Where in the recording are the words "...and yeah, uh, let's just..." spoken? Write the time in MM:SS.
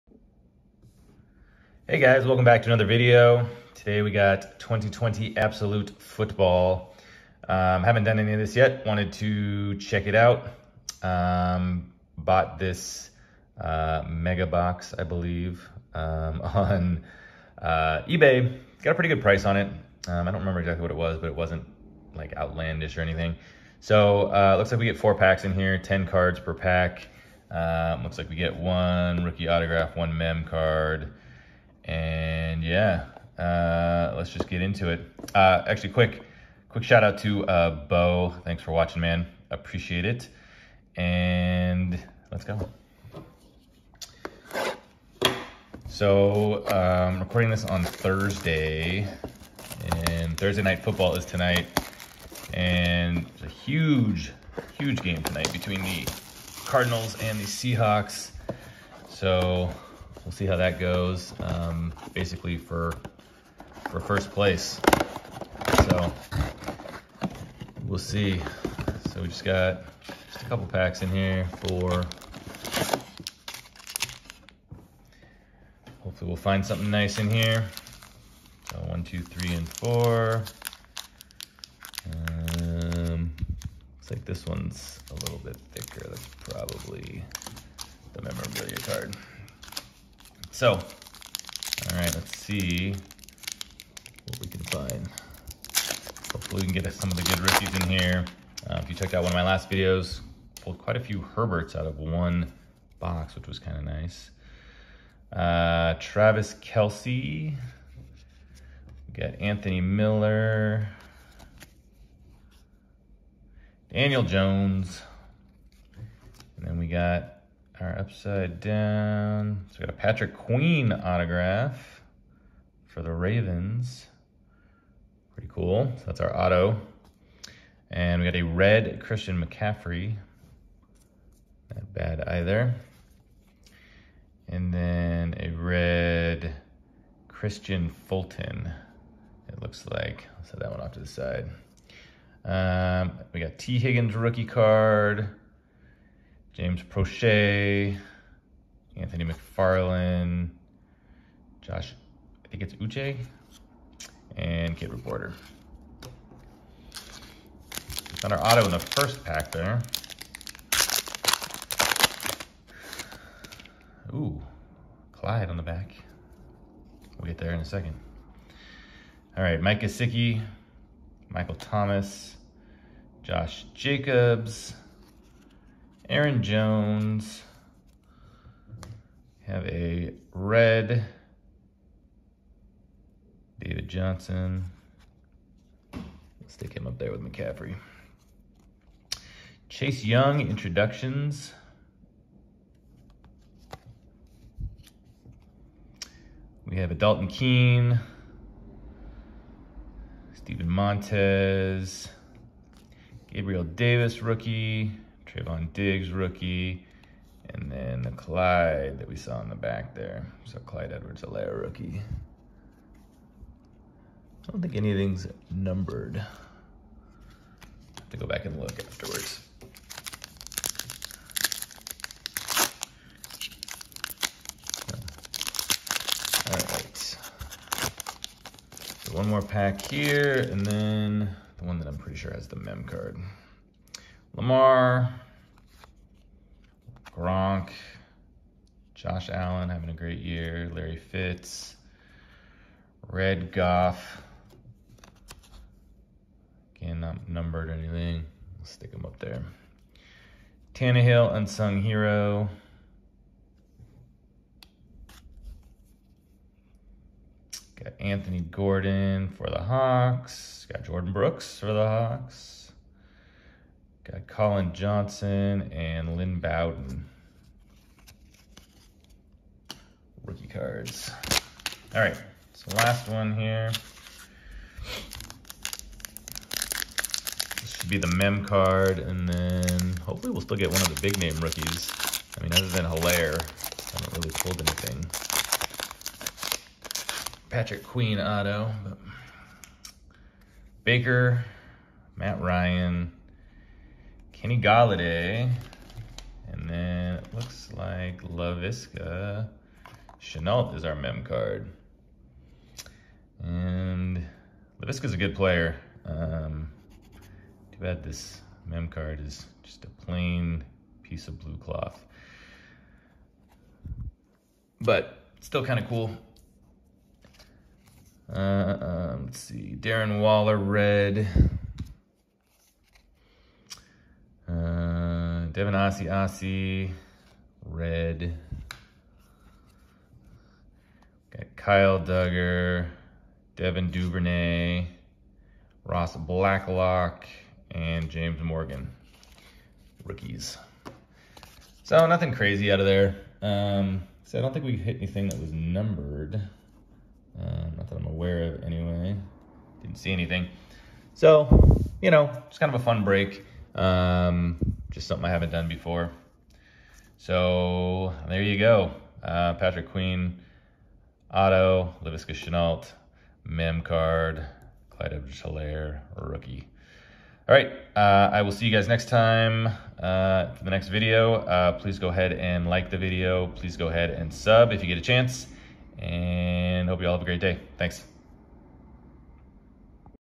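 00:31.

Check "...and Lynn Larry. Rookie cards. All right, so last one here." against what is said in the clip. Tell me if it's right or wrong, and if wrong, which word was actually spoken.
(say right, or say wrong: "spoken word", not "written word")
wrong: "Bowden", not "Larry".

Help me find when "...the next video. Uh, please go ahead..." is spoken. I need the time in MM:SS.
06:10.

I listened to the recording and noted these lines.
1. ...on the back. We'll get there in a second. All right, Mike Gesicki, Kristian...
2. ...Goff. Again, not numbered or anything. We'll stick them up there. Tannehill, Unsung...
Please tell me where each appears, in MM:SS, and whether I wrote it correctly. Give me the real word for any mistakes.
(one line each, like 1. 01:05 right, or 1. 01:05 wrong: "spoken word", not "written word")
1. 02:45 wrong: "Michael", not "Kristian"
2. 04:03 right.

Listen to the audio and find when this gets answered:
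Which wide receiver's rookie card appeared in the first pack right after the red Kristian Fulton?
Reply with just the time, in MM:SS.
02:23.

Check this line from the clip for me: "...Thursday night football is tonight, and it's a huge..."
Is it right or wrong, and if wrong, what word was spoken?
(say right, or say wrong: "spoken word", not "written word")
right.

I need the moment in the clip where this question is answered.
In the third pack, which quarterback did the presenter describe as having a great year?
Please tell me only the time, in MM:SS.
03:58.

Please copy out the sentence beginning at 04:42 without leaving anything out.
I mean, other than Helaire, I haven't really pulled anything.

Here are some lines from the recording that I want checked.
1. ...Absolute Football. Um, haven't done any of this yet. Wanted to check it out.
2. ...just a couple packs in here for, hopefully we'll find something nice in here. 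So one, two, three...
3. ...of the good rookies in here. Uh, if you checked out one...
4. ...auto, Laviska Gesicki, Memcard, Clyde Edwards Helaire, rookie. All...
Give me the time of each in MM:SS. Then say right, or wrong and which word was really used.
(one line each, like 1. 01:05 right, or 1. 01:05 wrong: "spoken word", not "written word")
1. 00:05 right
2. 01:10 right
3. 01:37 right
4. 06:01 wrong: "Shenault", not "Gesicki".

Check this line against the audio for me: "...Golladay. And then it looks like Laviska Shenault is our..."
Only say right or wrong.
right.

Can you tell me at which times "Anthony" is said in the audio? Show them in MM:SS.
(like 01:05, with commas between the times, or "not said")
01:49, 02:28, 04:17.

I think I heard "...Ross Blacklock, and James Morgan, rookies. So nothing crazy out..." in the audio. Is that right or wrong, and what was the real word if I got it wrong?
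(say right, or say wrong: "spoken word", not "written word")
right.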